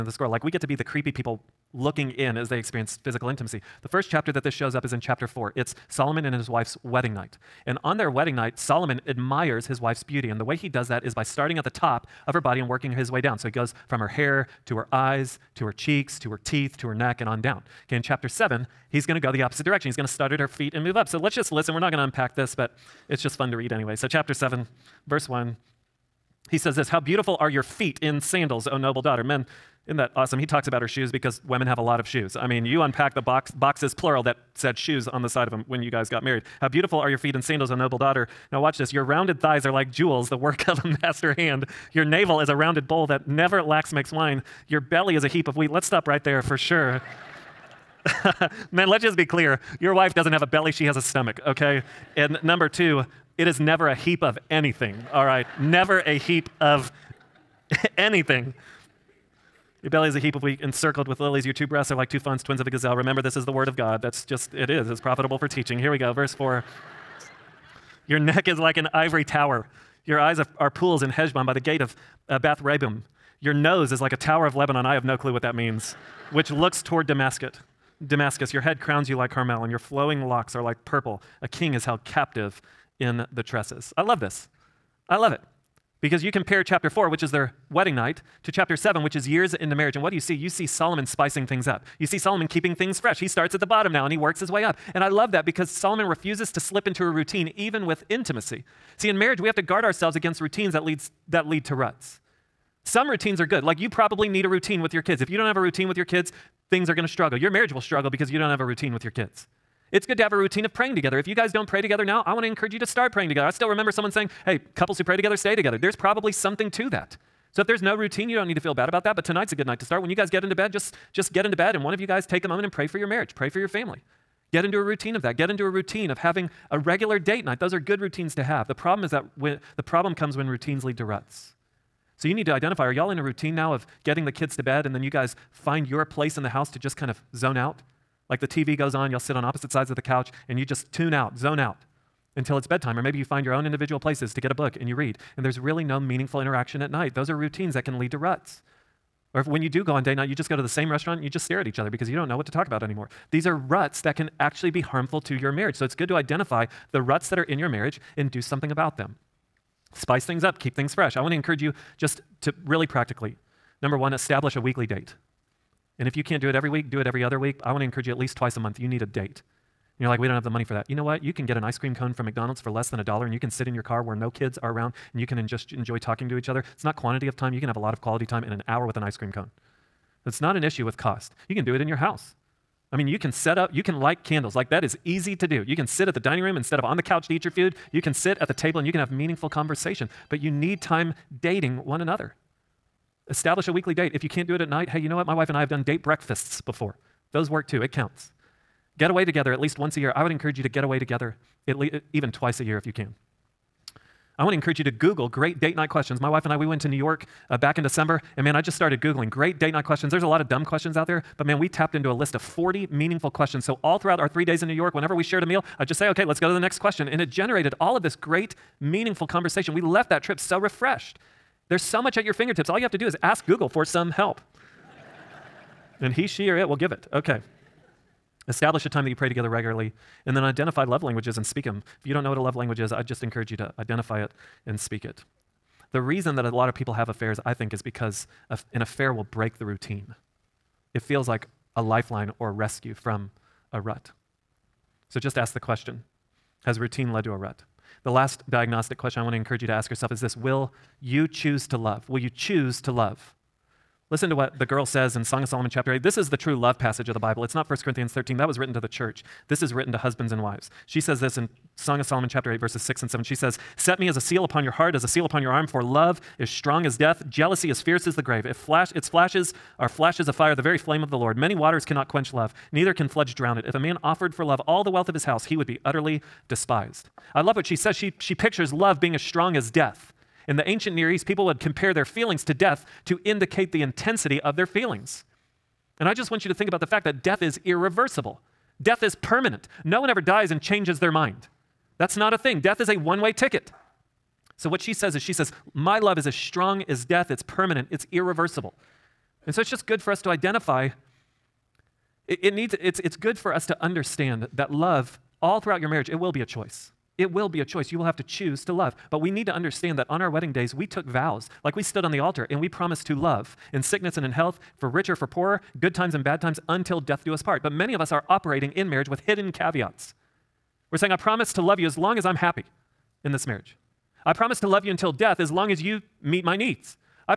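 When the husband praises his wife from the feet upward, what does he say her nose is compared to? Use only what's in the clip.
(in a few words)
A tower of Lebanon.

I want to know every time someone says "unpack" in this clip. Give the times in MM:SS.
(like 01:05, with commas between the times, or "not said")
00:22, 00:32.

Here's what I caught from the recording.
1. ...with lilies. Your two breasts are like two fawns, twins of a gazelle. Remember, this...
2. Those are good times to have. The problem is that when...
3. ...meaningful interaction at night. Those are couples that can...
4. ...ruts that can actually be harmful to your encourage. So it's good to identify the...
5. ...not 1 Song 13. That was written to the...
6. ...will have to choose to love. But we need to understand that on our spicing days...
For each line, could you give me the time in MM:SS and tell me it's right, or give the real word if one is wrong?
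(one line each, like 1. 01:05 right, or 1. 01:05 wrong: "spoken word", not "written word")
1. 01:01 right
2. 02:07 wrong: "routines", not "times"
3. 02:25 wrong: "routines", not "couples"
4. 02:33 wrong: "marriage", not "encourage"
5. 04:17 wrong: "Corinthians", not "Song"
6. 05:07 wrong: "wedding", not "spicing".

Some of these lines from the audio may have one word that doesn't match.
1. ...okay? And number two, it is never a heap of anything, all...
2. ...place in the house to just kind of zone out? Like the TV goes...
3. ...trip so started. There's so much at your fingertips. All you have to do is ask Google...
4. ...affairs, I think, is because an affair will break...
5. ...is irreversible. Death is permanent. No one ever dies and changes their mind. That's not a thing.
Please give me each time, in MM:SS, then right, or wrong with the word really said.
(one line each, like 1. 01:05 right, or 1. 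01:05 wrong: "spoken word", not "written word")
1. 00:51 right
2. 02:16 right
3. 03:40 wrong: "refreshed", not "started"
4. 03:57 right
5. 04:47 right.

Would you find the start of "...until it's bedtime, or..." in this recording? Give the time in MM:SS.
02:22.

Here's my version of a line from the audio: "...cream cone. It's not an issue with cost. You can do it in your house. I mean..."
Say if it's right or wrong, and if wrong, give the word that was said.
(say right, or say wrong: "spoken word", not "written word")
right.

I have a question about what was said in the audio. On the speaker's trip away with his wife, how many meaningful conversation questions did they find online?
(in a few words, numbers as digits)
40.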